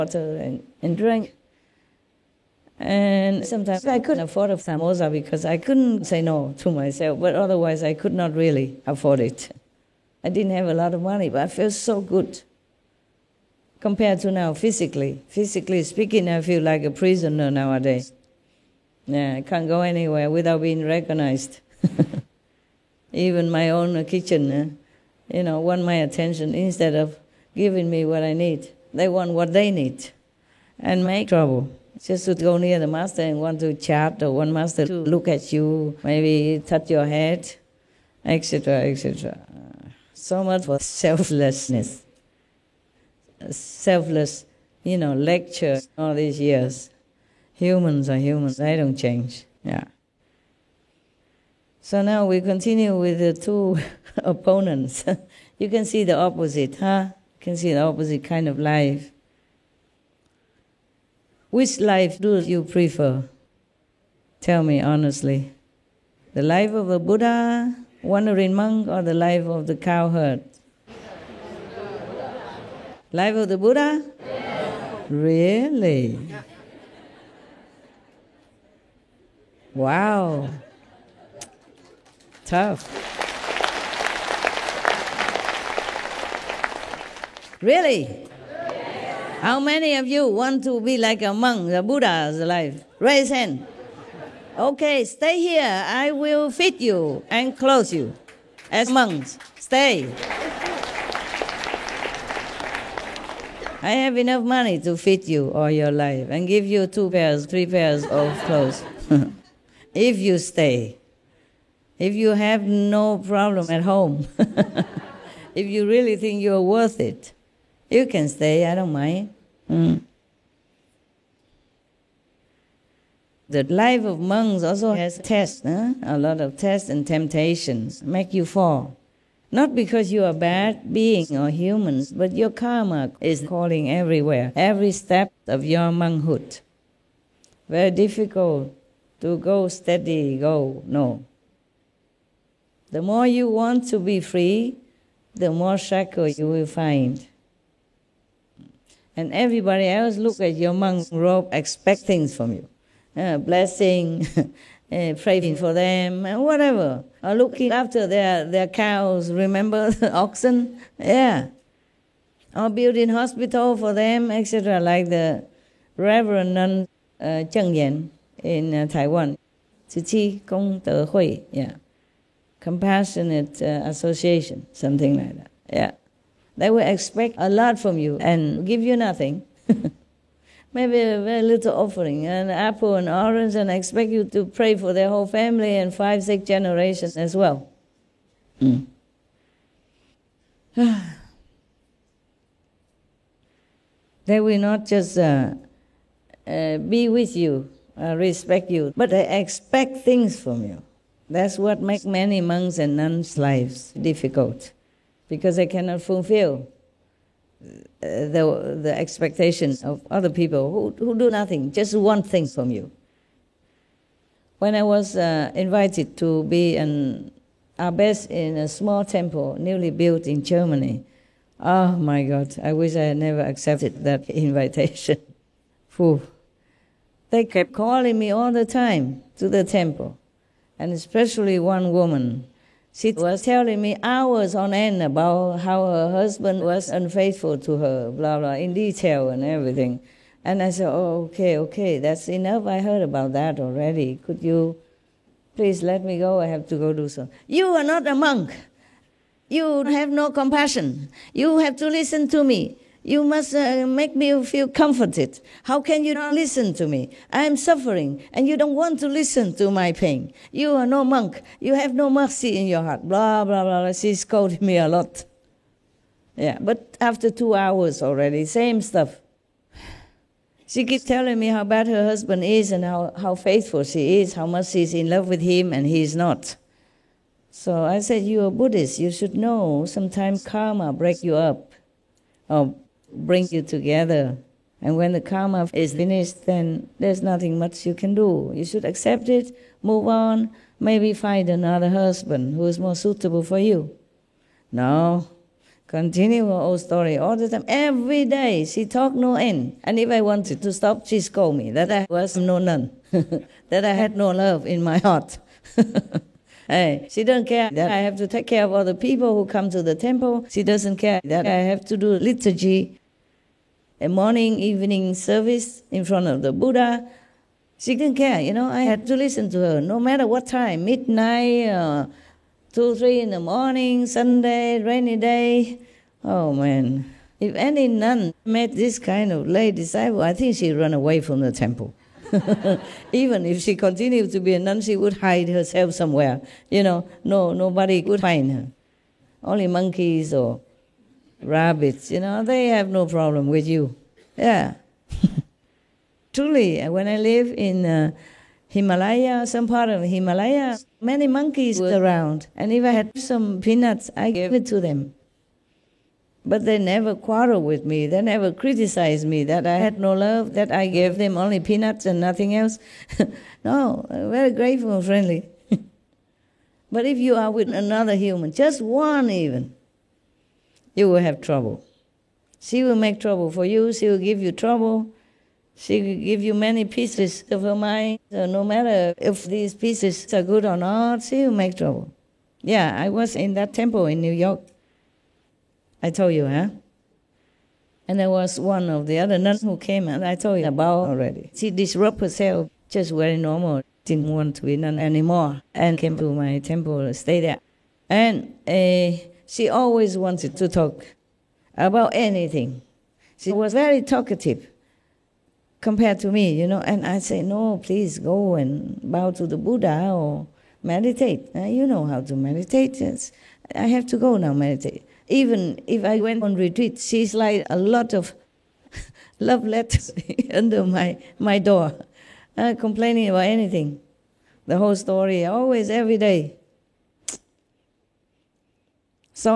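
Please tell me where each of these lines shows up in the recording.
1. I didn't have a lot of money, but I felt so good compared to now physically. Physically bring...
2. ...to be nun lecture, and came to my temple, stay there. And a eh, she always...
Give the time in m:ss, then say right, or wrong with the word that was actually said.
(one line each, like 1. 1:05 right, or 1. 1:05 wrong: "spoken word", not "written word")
1. 0:10 wrong: "speaking", not "bring"
2. 6:34 wrong: "anymore", not "lecture".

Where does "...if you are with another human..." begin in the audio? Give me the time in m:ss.
6:07.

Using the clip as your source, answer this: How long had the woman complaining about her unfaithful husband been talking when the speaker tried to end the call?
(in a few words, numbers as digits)
2.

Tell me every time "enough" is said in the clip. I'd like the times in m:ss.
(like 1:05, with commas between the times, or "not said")
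1:44, 4:02.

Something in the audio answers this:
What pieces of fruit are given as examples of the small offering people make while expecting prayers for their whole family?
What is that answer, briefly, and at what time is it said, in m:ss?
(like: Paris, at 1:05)
an apple, an orange, at 3:02.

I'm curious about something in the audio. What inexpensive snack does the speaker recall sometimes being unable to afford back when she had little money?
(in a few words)
samosa.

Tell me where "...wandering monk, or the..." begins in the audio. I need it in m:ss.
1:08.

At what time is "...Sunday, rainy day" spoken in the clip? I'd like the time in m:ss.
5:24.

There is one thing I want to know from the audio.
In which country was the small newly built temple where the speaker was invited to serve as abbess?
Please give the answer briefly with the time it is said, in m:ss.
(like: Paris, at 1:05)
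Germany, at 3:40.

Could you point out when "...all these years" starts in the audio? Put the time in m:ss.
0:45.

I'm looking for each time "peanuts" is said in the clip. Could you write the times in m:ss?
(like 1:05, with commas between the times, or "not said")
5:53, 6:01.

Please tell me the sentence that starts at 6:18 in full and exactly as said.
So no matter if these pieces are good or not, she will make trouble.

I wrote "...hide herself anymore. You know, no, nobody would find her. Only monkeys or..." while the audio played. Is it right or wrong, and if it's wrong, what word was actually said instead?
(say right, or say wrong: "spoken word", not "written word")
wrong: "somewhere", not "anymore".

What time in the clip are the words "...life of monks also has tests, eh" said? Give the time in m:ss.
2:03.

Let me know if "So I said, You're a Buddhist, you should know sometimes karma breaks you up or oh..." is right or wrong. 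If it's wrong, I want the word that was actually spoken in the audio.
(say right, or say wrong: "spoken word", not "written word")
right.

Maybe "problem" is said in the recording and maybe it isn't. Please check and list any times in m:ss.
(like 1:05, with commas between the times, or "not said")
1:53, 5:43.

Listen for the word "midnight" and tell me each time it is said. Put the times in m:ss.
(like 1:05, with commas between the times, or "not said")
5:20.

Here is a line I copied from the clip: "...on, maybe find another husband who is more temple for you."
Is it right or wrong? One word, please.
wrong.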